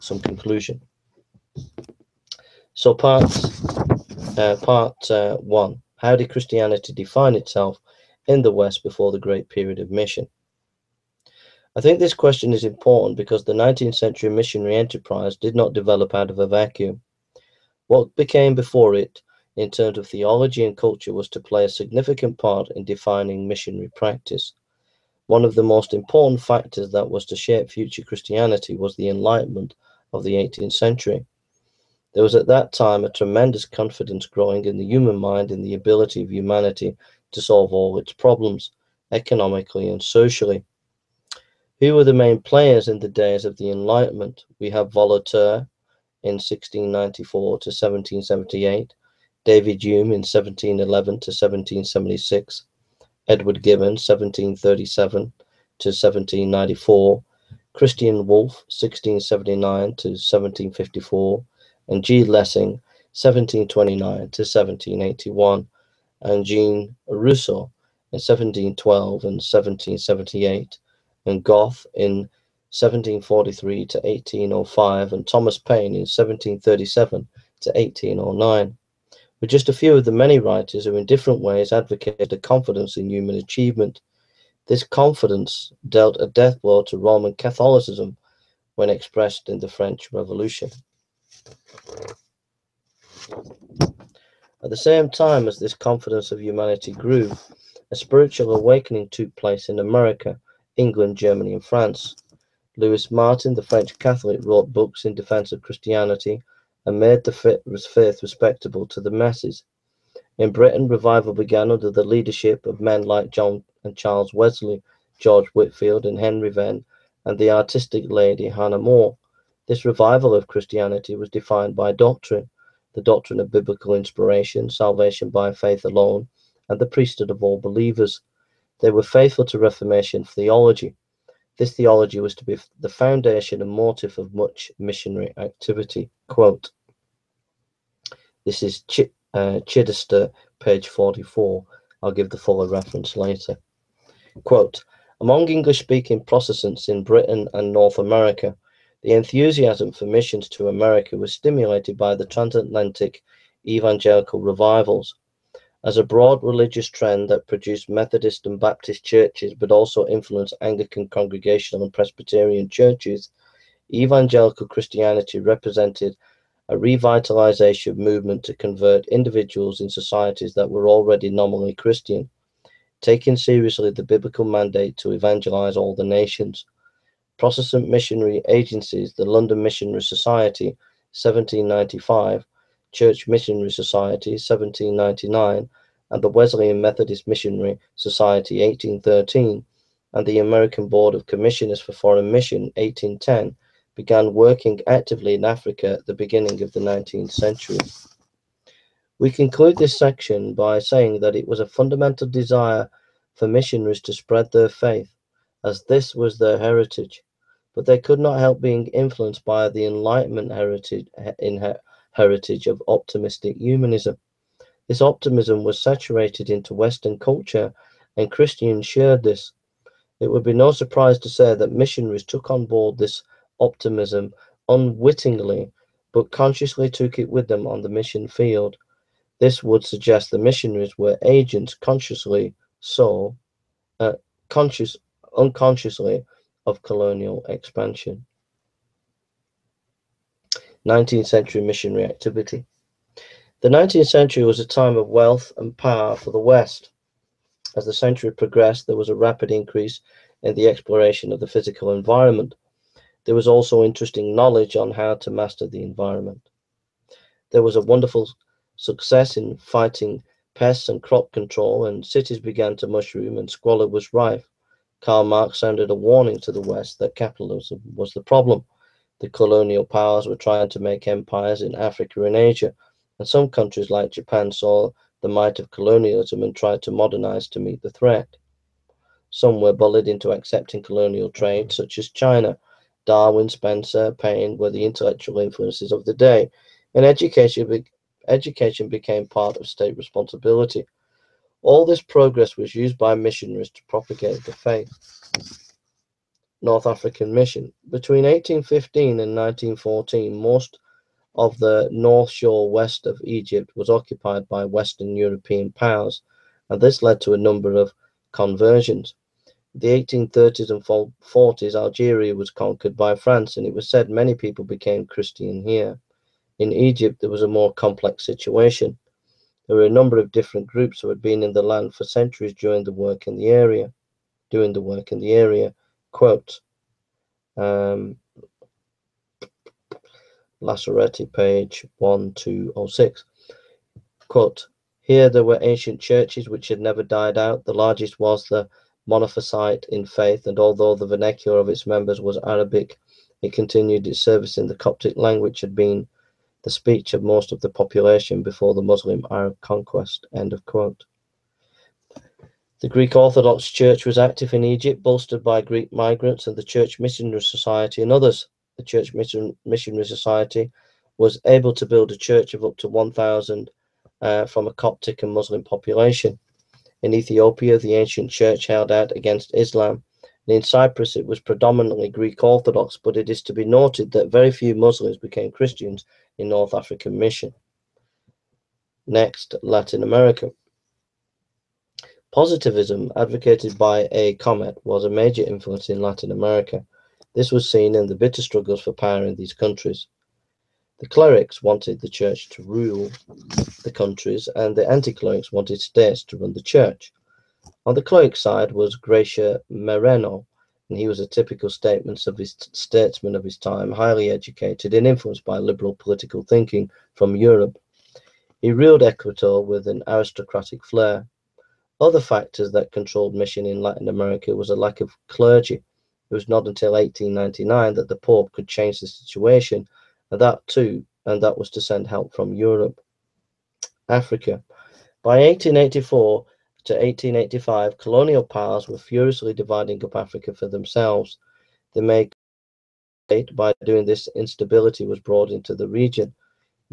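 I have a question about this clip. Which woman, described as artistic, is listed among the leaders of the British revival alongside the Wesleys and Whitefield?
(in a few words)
Hannah More.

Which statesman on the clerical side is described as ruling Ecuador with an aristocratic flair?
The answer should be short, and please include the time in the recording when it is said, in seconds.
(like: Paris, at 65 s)
Garcia Moreno, at 398 s.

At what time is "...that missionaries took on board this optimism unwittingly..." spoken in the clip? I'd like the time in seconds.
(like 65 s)
221 s.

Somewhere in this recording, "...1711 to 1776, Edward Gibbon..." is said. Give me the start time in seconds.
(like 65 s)
50 s.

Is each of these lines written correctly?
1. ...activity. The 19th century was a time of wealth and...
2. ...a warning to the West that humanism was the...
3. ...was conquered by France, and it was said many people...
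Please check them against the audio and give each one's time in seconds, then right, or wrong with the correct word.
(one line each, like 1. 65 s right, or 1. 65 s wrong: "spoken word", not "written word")
1. 242 s right
2. 265 s wrong: "capitalism", not "humanism"
3. 312 s right.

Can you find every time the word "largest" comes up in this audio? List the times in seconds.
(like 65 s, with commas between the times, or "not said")
337 s.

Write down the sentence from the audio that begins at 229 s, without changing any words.
This would suggest the missionaries were agents consciously so, uh, conscious, unconsciously of colonial expansion.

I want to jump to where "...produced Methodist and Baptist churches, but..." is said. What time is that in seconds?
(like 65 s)
157 s.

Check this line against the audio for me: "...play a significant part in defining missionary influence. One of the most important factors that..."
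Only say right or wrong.
wrong.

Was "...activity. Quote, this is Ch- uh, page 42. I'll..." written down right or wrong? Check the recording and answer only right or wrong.
wrong.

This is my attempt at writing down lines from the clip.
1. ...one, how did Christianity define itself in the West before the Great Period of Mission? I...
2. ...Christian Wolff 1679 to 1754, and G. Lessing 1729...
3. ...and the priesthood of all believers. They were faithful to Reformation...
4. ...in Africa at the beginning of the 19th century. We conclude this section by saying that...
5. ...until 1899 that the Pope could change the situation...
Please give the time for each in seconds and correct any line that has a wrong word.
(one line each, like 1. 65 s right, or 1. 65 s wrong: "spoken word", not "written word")
1. 5 s right
2. 57 s right
3. 126 s right
4. 195 s right
5. 416 s right.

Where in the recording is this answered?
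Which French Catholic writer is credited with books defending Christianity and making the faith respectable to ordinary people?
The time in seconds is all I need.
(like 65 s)
102 s.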